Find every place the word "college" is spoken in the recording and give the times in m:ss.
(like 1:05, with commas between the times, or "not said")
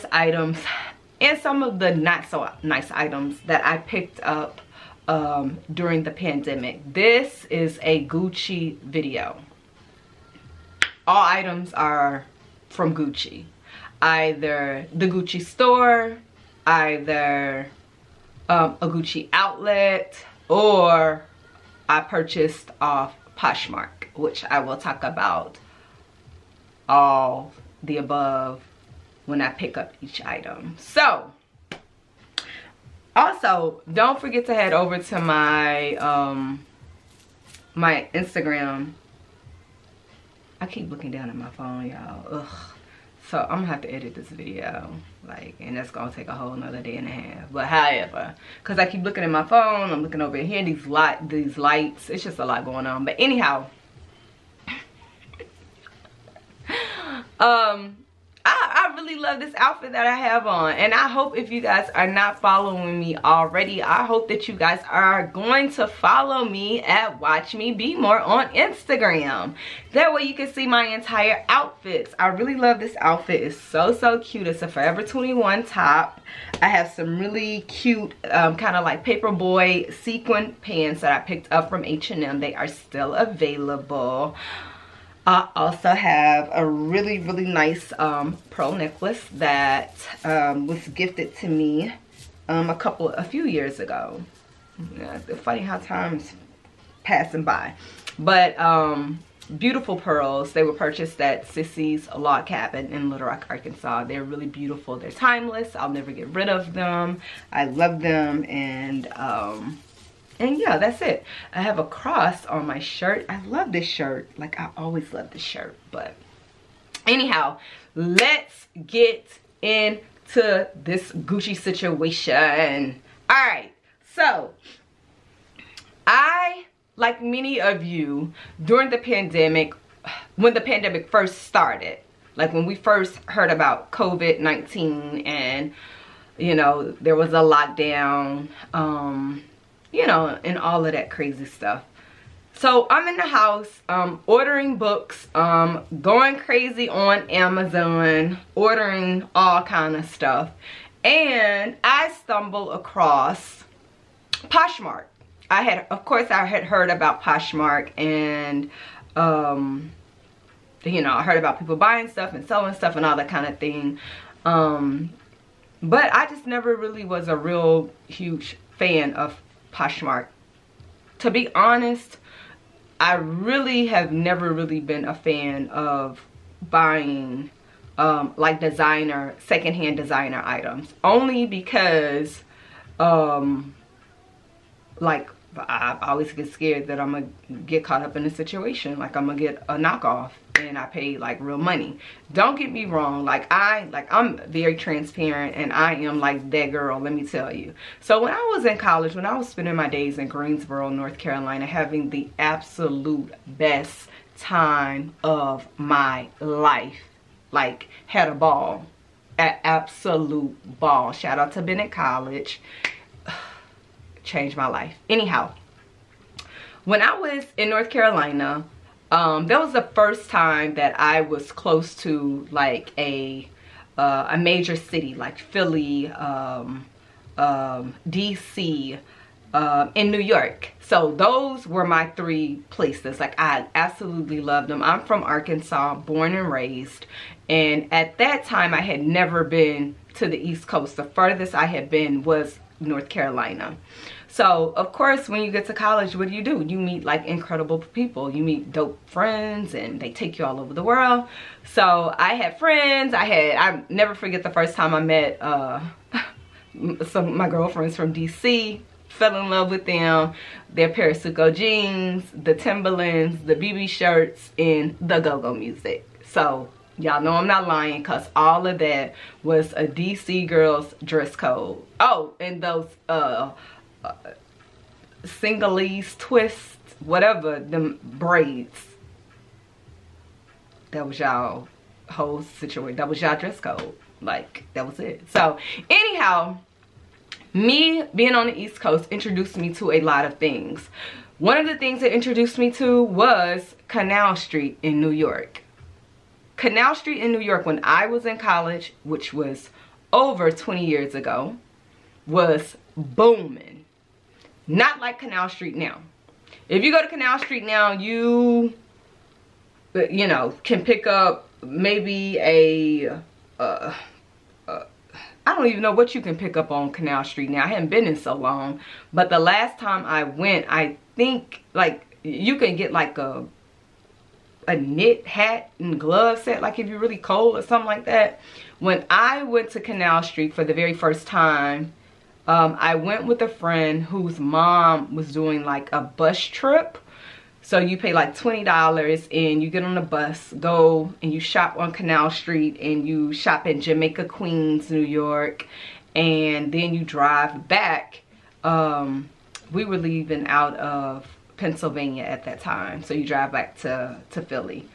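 3:18, 3:31, 4:05, 4:58.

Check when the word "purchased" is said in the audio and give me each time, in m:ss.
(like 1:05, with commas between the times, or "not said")
0:22, 1:40.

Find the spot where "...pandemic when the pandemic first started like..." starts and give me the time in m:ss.
2:08.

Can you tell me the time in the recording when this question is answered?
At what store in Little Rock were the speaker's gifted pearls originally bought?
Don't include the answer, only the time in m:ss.
1:41.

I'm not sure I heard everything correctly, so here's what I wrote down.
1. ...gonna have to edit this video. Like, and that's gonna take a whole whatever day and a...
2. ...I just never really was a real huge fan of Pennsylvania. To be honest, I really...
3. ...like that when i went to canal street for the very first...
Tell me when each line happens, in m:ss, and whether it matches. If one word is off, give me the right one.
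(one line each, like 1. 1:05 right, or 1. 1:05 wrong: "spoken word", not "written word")
1. 0:43 wrong: "nother", not "whatever"
2. 2:46 wrong: "Poshmark", not "Pennsylvania"
3. 5:27 right.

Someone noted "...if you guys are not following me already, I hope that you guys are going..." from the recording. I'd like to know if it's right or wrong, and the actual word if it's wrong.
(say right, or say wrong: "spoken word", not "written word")
right.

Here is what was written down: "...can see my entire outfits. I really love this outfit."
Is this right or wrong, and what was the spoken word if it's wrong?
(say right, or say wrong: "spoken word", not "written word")
right.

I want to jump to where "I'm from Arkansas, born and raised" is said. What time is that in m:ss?
3:54.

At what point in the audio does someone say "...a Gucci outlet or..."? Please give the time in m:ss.
0:18.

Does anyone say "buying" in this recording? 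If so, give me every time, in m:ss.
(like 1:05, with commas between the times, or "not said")
2:41, 2:56.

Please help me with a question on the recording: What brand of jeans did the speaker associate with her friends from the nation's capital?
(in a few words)
Parasuco.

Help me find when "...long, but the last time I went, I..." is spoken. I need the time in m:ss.
5:18.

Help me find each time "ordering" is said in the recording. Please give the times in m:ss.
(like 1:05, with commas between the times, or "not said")
2:24, 2:28.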